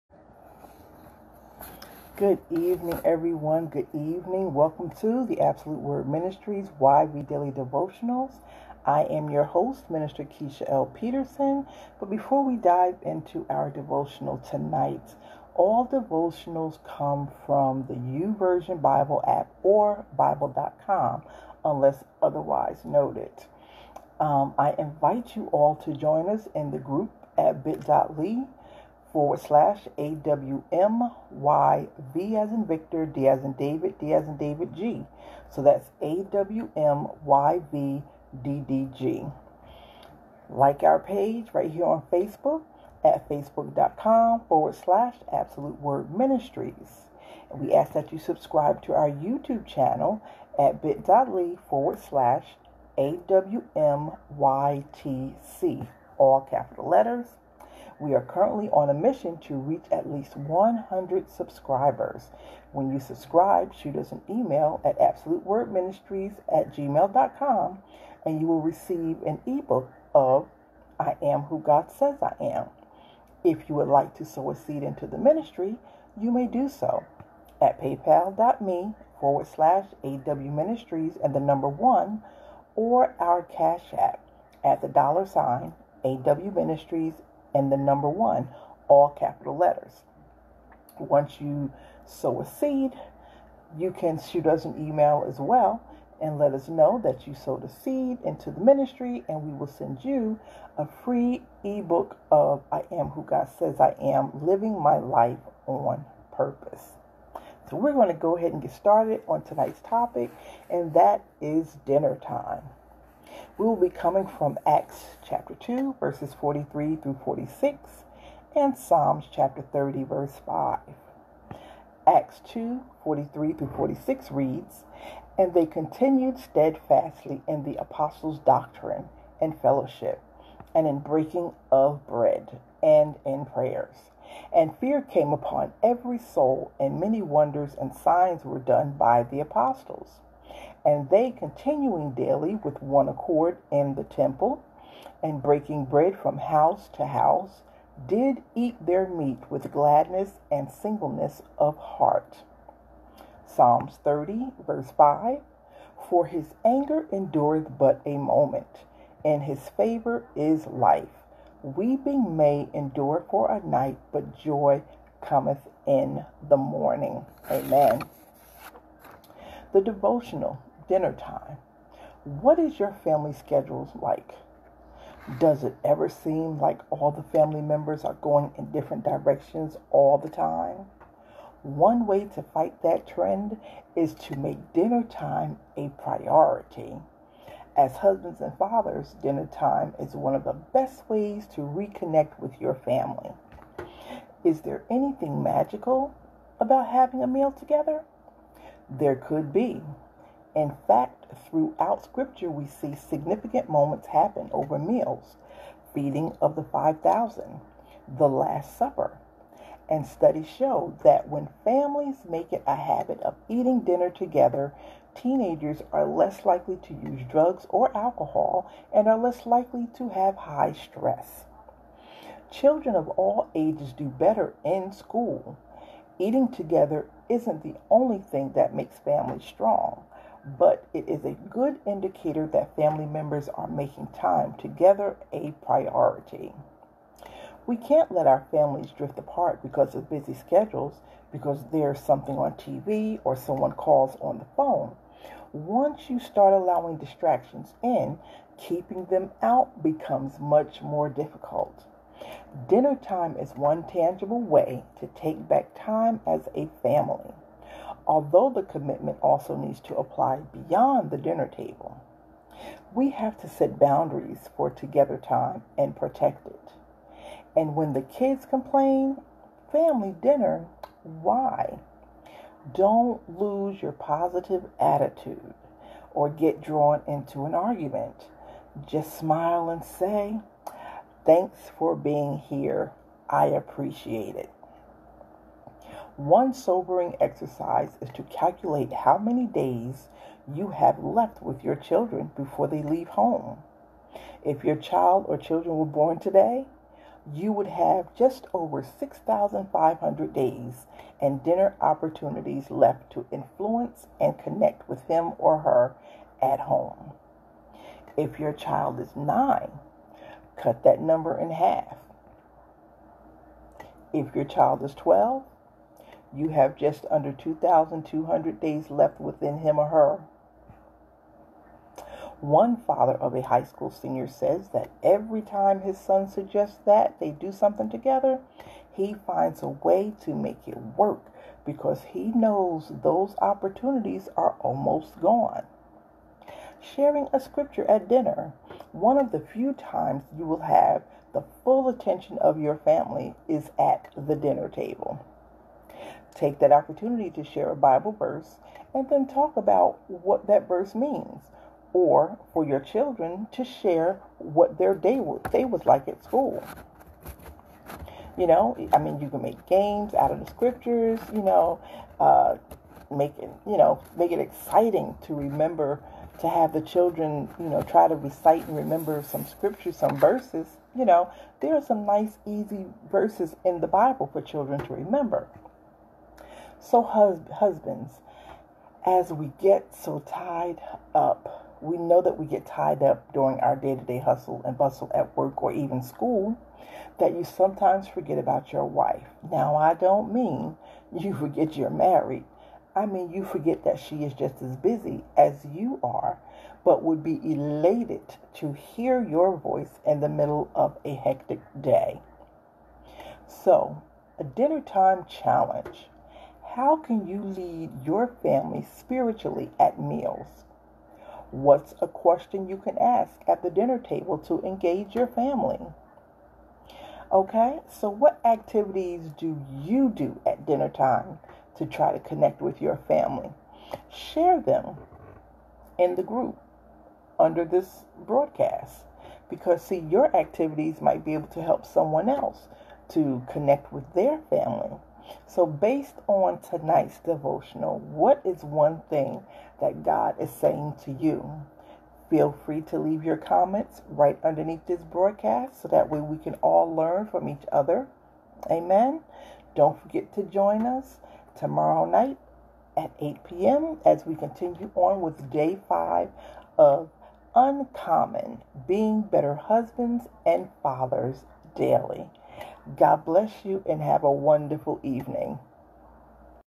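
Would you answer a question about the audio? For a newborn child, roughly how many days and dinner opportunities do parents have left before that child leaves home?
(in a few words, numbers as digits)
6,500.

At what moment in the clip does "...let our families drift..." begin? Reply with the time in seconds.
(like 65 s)
238 s.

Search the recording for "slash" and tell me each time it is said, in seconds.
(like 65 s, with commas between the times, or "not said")
29 s, 44 s, 51 s, 79 s.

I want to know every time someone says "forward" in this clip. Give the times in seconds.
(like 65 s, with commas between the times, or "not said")
29 s, 44 s, 51 s, 79 s.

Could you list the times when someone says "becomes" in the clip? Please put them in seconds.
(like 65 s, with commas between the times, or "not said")
249 s.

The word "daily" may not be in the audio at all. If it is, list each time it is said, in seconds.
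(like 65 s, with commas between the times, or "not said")
7 s, 142 s, 461 s.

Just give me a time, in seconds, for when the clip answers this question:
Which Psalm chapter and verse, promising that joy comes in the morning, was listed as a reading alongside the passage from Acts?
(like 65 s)
118 s.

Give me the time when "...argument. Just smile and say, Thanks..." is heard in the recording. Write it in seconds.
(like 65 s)
277 s.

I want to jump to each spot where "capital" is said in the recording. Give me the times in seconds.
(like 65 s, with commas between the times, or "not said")
56 s, 89 s.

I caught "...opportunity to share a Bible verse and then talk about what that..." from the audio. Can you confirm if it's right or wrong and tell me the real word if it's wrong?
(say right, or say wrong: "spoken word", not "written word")
right.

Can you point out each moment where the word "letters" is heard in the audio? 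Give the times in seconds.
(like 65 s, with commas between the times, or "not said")
56 s, 89 s.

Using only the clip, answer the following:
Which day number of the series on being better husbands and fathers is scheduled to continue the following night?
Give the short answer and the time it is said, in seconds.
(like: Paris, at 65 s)
Day 5, at 455 s.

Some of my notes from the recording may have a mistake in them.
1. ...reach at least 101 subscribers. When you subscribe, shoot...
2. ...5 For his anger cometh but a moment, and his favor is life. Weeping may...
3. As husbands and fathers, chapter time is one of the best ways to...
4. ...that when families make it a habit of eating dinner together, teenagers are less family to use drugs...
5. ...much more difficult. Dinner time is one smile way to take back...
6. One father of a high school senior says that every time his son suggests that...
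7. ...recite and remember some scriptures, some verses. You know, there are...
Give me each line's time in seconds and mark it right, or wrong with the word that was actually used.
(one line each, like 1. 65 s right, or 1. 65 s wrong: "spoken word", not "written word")
1. 59 s wrong: "100", not "101"
2. 154 s wrong: "endureth", not "cometh"
3. 187 s wrong: "dinner", not "chapter"
4. 211 s wrong: "likely", not "family"
5. 250 s wrong: "tangible", not "smile"
6. 322 s right
7. 368 s right.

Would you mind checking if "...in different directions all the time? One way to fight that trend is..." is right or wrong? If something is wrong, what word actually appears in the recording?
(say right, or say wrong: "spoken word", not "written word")
right.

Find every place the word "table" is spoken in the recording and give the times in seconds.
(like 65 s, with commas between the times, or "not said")
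261 s, 344 s, 413 s.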